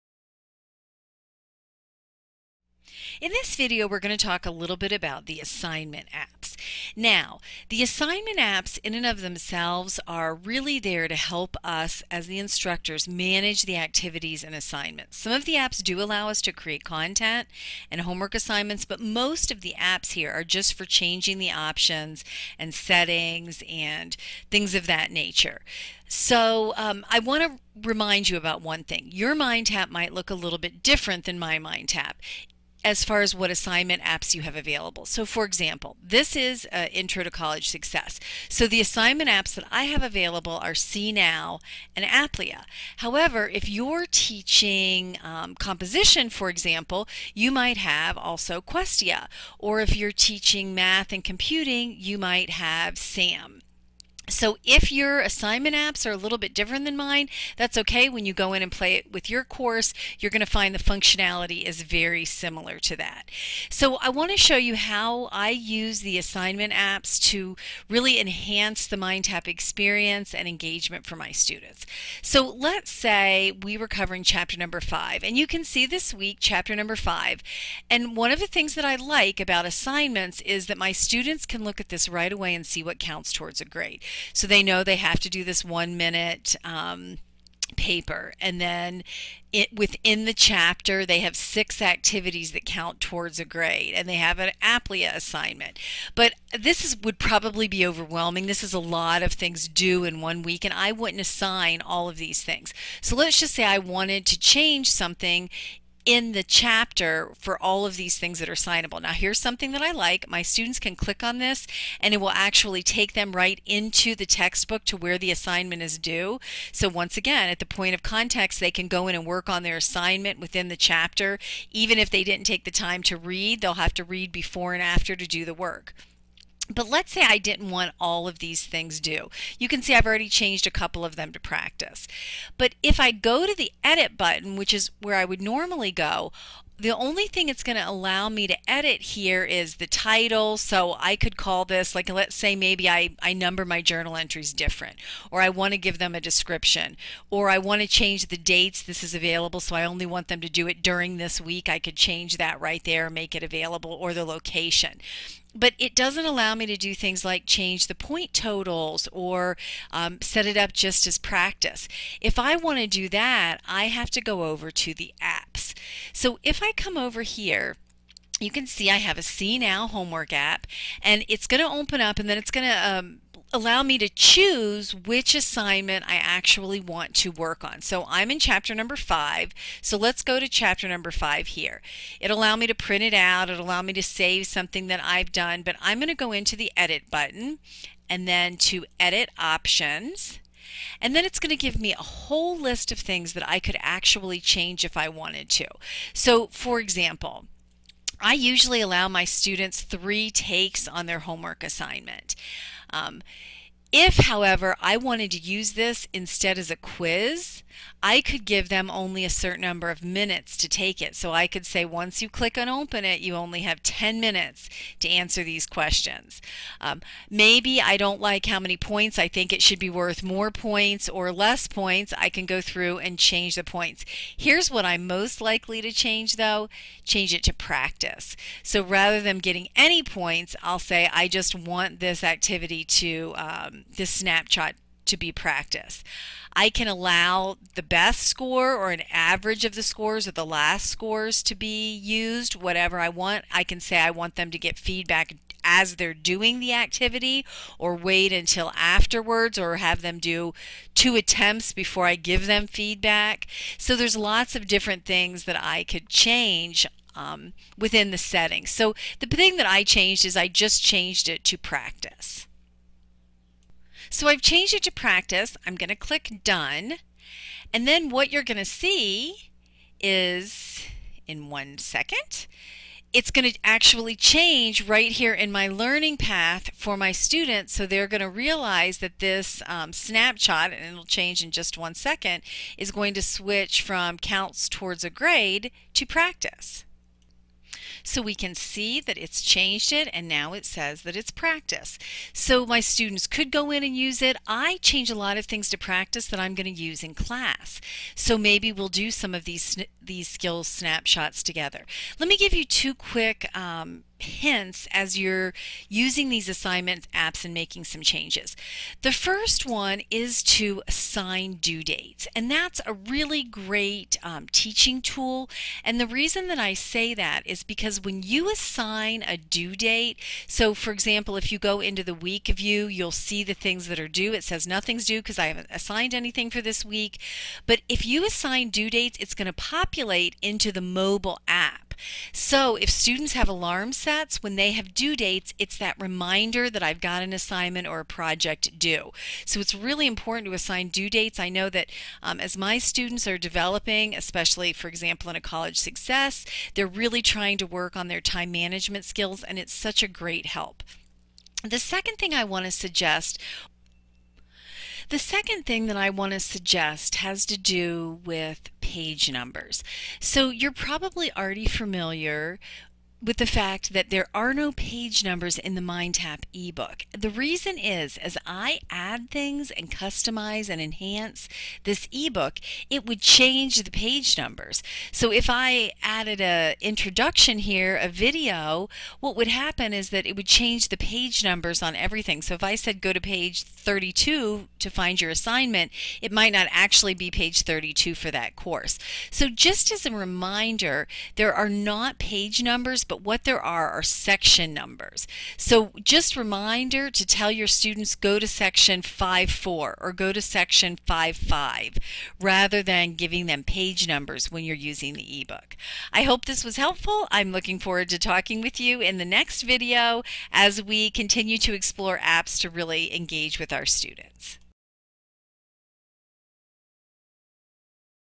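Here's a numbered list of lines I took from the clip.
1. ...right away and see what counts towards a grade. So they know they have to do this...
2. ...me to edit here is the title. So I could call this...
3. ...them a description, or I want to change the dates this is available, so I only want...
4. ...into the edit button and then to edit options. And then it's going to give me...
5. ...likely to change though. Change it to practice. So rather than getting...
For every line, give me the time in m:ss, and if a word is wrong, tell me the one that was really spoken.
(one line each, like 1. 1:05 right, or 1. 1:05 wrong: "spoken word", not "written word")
1. 1:22 right
2. 2:18 right
3. 2:25 right
4. 3:06 right
5. 3:45 right.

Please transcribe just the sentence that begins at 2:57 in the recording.
So I'm in chapter number five.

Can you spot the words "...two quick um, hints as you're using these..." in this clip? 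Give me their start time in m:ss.
5:02.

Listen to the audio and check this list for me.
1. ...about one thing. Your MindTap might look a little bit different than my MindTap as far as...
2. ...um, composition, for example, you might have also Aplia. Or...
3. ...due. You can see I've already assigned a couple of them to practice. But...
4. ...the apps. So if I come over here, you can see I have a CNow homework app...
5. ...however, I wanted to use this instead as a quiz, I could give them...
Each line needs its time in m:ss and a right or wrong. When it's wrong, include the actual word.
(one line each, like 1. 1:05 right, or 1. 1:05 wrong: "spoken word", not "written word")
1. 0:28 right
2. 0:45 wrong: "Questia", not "Aplia"
3. 2:08 wrong: "changed", not "assigned"
4. 2:44 right
5. 3:24 right.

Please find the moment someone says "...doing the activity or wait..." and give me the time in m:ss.
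4:06.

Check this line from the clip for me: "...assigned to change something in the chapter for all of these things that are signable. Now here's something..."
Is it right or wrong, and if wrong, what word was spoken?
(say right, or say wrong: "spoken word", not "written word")
wrong: "wanted", not "assigned".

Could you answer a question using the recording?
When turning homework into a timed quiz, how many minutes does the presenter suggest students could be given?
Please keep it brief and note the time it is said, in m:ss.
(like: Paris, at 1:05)
10, at 3:33.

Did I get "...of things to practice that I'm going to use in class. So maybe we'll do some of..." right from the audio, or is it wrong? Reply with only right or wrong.
right.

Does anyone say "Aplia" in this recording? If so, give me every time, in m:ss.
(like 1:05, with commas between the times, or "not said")
0:42, 1:34.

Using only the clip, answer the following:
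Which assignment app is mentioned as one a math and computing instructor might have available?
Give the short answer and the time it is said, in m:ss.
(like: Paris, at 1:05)
SAM, at 0:52.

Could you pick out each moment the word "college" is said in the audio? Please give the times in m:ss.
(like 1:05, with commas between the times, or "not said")
0:37, 5:45.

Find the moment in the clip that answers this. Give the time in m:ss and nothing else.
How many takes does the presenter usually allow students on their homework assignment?
3:19.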